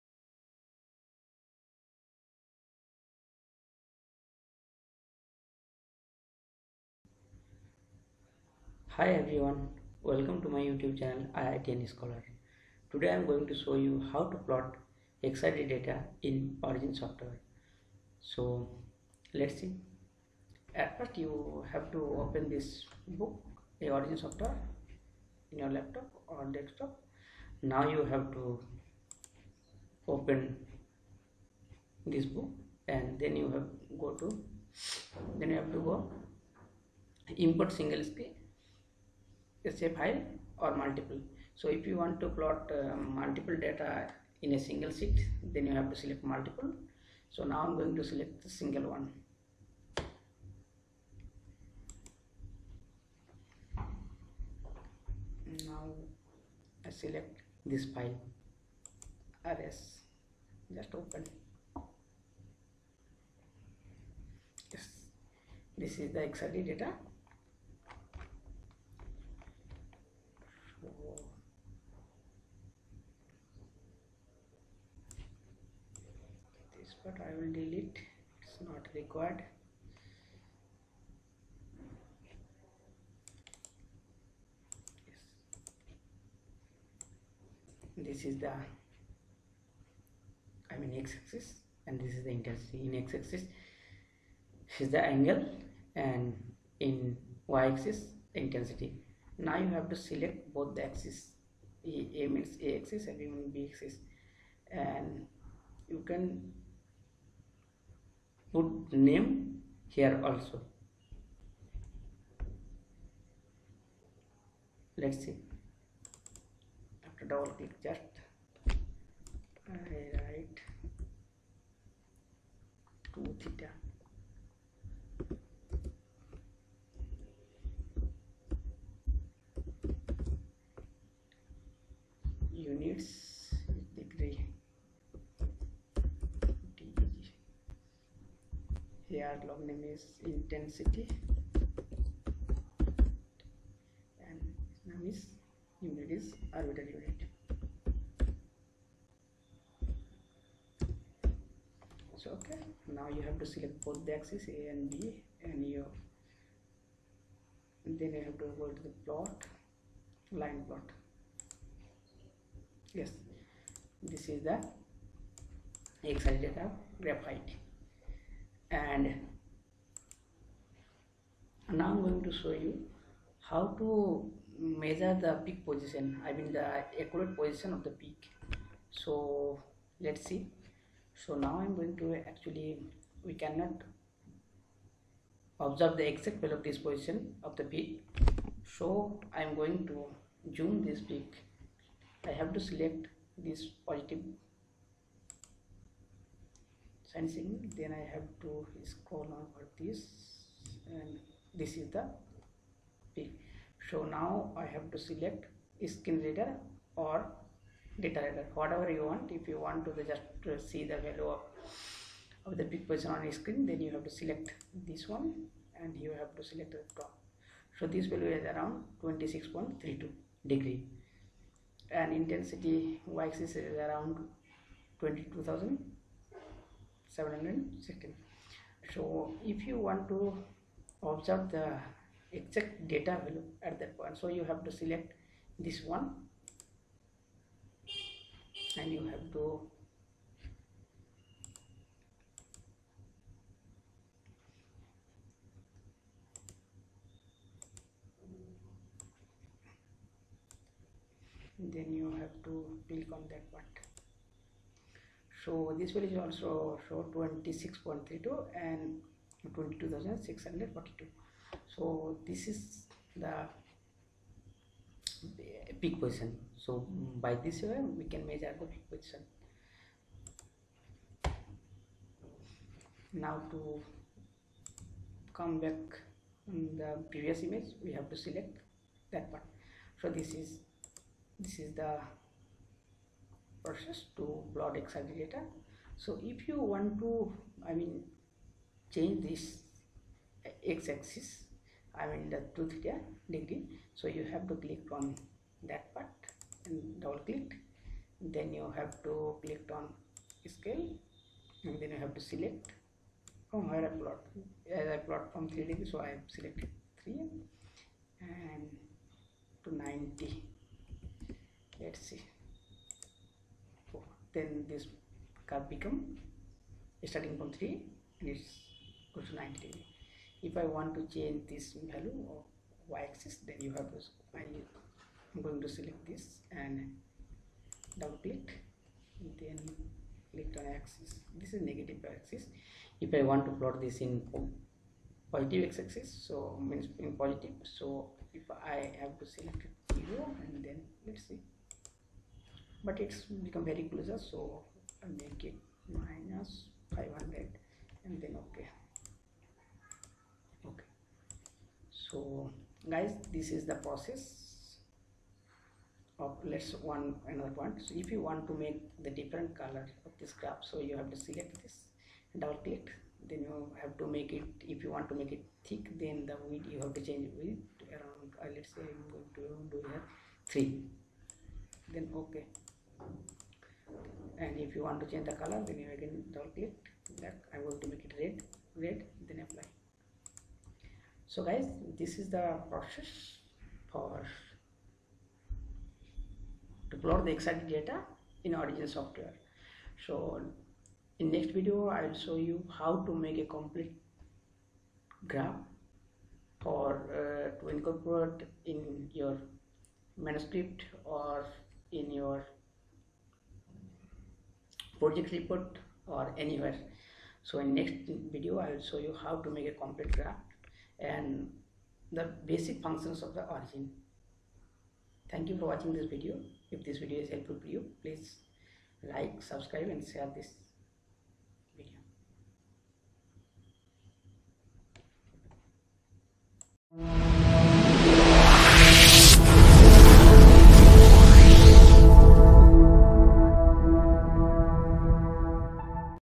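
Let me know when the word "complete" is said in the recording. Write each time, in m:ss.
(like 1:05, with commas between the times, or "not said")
6:33, 6:49.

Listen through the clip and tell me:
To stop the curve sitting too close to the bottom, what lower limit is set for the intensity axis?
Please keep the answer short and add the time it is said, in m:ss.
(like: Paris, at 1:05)
-500, at 5:45.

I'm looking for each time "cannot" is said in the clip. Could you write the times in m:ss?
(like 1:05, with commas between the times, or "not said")
3:03.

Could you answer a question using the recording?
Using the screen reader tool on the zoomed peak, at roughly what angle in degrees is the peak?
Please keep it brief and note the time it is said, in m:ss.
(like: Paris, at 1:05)
26.32 degrees, at 3:39.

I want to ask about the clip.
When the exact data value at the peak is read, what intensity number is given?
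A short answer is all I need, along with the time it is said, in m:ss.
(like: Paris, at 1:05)
22,642, at 4:19.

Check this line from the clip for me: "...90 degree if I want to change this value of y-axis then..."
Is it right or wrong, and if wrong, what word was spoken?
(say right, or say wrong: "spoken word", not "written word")
right.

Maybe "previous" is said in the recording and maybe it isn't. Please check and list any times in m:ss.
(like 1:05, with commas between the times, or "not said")
4:37.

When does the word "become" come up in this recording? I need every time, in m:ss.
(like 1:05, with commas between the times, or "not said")
5:15, 5:43.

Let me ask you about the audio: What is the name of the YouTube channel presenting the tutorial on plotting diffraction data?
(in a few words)
IITian Scholar.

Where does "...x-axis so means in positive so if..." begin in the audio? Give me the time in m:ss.
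5:35.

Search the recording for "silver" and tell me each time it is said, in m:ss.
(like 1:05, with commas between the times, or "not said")
not said.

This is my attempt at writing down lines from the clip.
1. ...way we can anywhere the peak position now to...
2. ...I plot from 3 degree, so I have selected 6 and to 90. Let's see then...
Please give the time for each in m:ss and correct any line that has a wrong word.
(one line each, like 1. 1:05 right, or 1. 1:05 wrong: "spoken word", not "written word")
1. 4:27 wrong: "measure", not "anywhere"
2. 5:04 wrong: "3", not "6".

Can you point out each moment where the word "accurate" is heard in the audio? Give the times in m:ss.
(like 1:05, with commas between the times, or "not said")
2:56.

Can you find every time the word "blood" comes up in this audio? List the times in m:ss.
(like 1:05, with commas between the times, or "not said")
4:44.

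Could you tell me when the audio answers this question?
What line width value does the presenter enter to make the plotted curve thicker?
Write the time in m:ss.
6:10.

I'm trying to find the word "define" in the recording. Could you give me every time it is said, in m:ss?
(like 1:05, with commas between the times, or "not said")
not said.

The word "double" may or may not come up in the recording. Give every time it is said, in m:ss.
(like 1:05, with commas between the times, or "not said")
1:57, 4:57, 5:27, 6:02, 6:16.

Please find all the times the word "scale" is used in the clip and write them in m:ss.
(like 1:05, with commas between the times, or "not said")
5:00.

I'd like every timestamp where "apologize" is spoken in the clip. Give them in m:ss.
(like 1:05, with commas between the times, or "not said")
not said.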